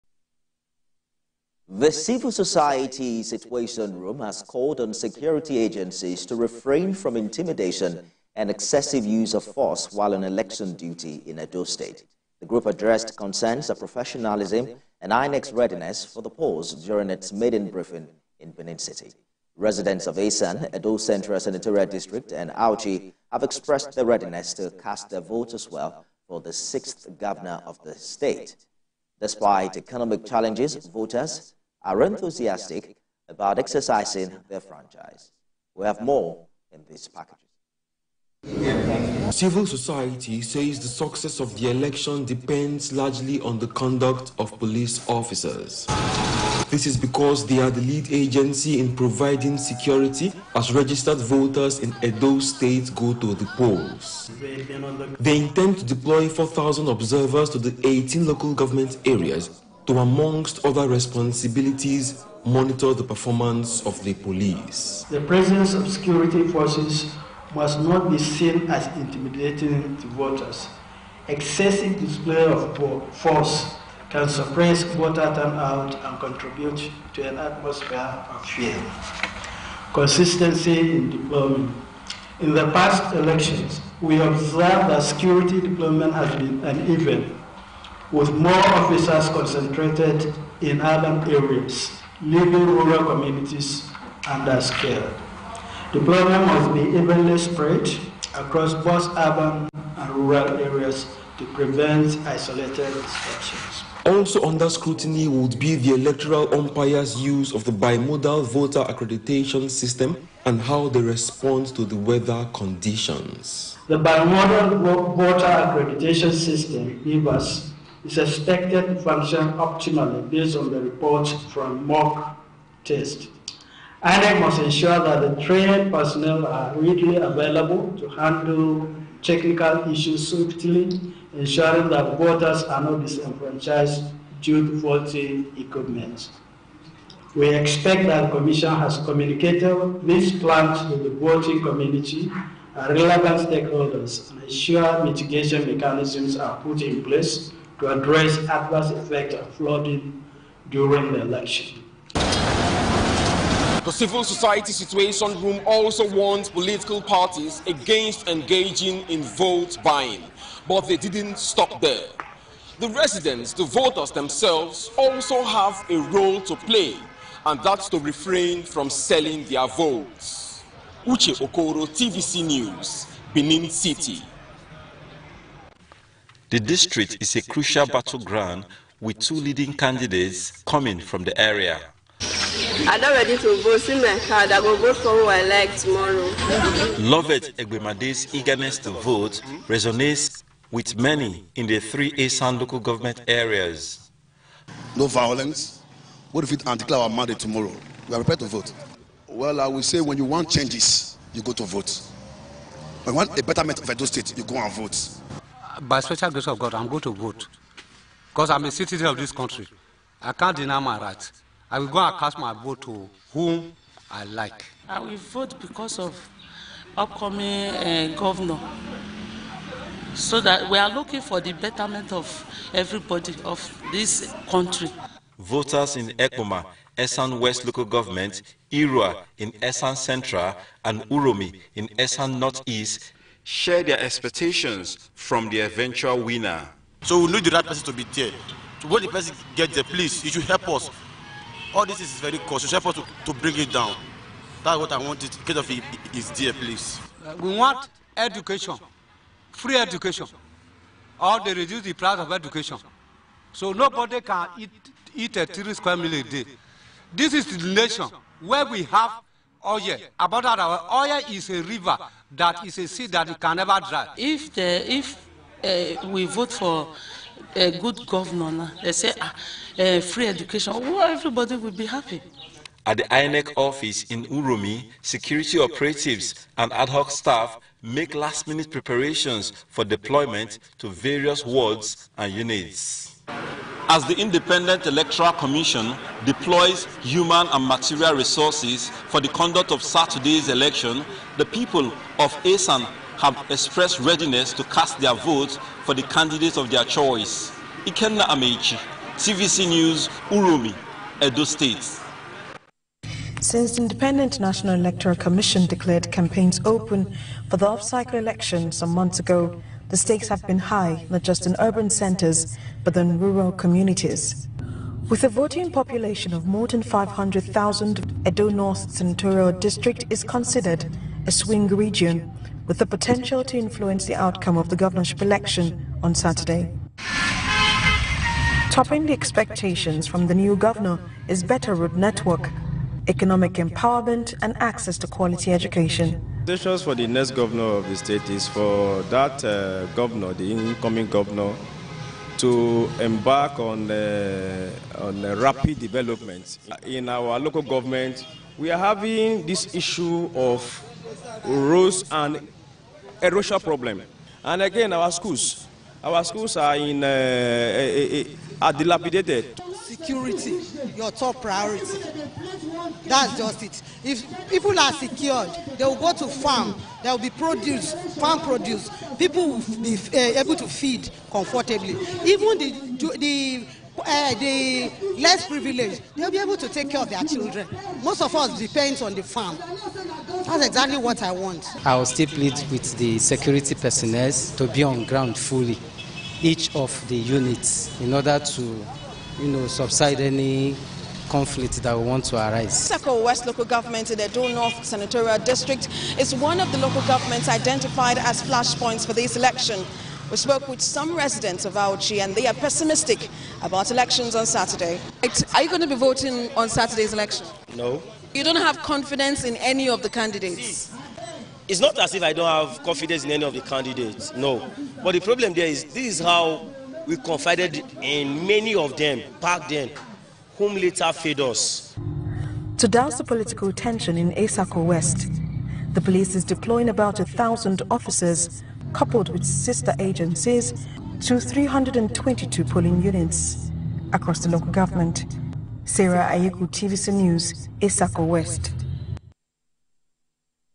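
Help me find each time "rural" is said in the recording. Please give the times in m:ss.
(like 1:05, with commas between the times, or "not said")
1:32, 1:40, 5:13.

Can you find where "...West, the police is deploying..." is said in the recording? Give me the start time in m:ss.
7:04.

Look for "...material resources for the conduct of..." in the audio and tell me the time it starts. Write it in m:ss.
4:47.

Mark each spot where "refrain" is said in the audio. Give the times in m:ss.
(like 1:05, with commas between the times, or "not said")
0:06, 2:47.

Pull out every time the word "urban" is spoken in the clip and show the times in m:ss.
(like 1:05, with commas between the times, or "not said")
1:30, 1:39, 5:11.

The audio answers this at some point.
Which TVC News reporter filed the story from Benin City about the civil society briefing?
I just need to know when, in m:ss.
2:51.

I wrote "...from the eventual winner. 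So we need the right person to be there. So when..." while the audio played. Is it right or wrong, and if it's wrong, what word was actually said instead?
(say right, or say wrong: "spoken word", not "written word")
right.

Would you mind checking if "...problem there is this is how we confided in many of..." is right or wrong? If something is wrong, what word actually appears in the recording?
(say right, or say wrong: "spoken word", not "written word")
right.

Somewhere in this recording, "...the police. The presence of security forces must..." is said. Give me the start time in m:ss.
1:04.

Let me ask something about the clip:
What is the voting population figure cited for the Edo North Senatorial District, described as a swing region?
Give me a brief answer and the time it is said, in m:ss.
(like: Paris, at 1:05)
More than 500,000, at 5:16.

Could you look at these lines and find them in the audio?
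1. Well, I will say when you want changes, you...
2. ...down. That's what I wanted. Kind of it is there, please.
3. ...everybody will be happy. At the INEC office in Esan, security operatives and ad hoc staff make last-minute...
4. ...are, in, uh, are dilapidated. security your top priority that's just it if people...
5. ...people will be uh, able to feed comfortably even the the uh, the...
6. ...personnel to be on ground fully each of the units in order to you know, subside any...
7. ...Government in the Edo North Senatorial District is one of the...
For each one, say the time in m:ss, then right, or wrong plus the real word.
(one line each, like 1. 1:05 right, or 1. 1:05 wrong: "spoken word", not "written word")
1. 3:19 right
2. 4:03 right
3. 4:31 wrong: "Uromi", not "Esan"
4. 5:56 right
5. 6:09 right
6. 6:23 right
7. 6:33 right.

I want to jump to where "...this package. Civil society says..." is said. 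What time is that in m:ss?
0:36.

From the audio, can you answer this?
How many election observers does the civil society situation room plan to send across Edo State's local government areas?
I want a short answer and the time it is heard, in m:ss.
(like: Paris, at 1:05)
4,000, at 0:56.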